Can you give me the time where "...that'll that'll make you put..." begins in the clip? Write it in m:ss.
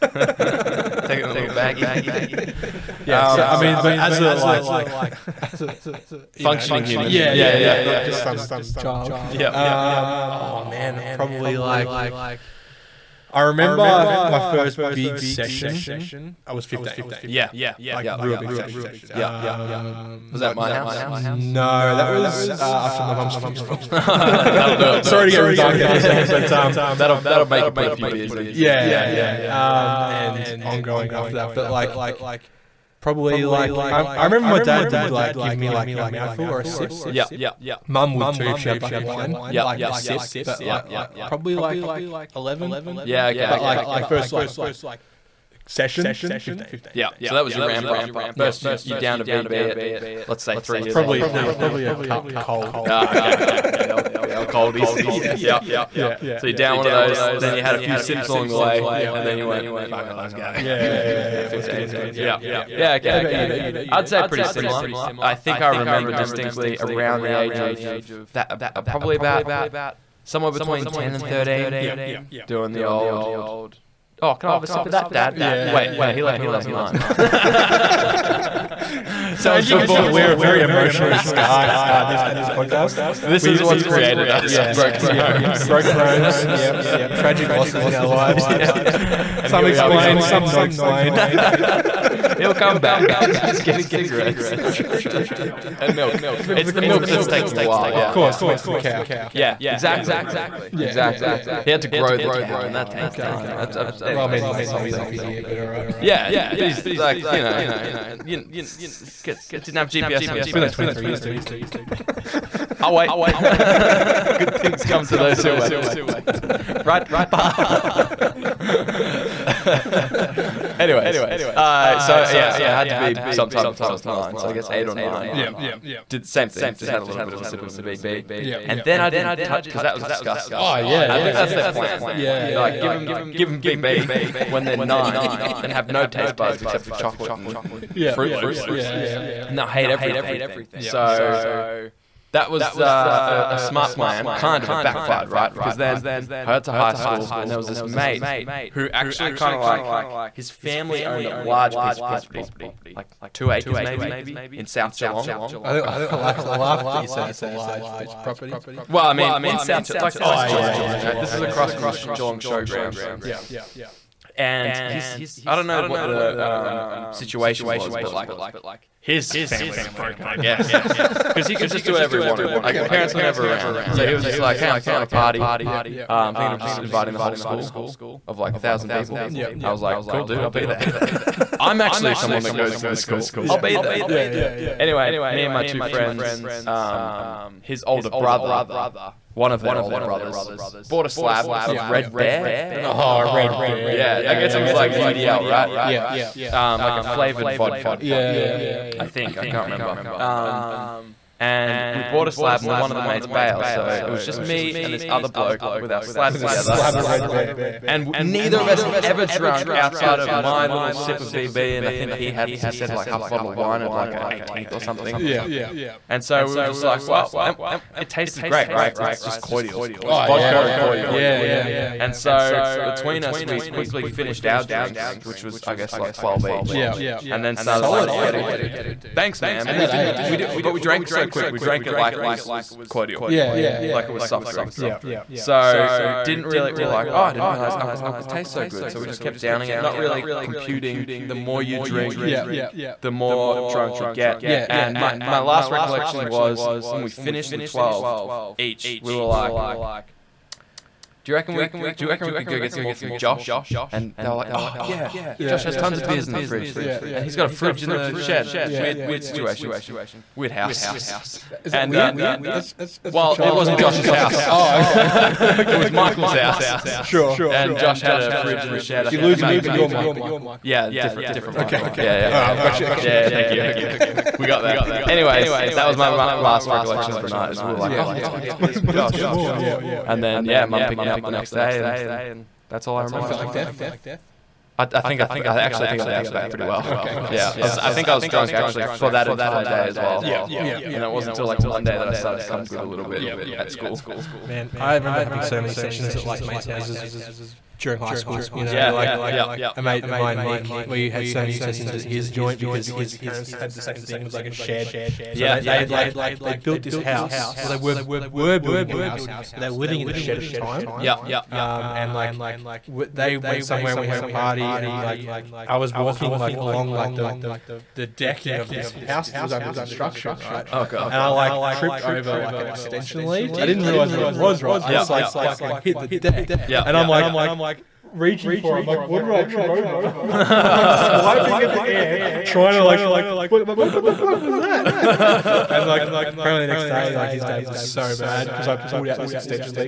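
0:26.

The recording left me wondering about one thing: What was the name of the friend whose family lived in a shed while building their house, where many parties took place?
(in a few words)
Nick.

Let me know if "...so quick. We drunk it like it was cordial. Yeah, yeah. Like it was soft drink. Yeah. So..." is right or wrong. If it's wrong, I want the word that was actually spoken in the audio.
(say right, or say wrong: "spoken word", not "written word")
wrong: "drank", not "drunk".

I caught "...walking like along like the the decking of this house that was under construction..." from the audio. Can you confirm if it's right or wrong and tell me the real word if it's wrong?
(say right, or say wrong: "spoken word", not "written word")
right.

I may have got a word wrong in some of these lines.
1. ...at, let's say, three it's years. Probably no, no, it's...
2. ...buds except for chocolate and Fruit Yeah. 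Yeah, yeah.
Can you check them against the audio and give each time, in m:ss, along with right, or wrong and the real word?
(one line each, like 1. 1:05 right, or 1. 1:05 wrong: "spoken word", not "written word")
1. 0:49 right
2. 2:16 wrong: "Loops", not "Yeah".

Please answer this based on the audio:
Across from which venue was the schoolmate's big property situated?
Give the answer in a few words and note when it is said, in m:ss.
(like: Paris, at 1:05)
Geelong Showgrounds, at 2:42.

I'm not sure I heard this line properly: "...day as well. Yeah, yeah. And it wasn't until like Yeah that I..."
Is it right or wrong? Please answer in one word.
wrong.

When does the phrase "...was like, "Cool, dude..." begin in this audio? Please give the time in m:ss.
2:59.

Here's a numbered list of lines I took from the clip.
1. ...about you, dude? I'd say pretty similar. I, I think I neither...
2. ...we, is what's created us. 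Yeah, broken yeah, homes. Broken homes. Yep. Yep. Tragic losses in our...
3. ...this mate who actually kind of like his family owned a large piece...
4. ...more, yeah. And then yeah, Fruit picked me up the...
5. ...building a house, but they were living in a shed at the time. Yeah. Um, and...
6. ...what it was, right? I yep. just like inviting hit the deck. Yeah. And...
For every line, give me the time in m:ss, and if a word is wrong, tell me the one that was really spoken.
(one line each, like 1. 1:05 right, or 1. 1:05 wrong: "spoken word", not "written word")
1. 1:03 wrong: "remember", not "neither"
2. 1:23 right
3. 2:27 right
4. 4:39 wrong: "Mum", not "Fruit"
5. 5:08 right
6. 5:24 wrong: "fucking", not "inviting".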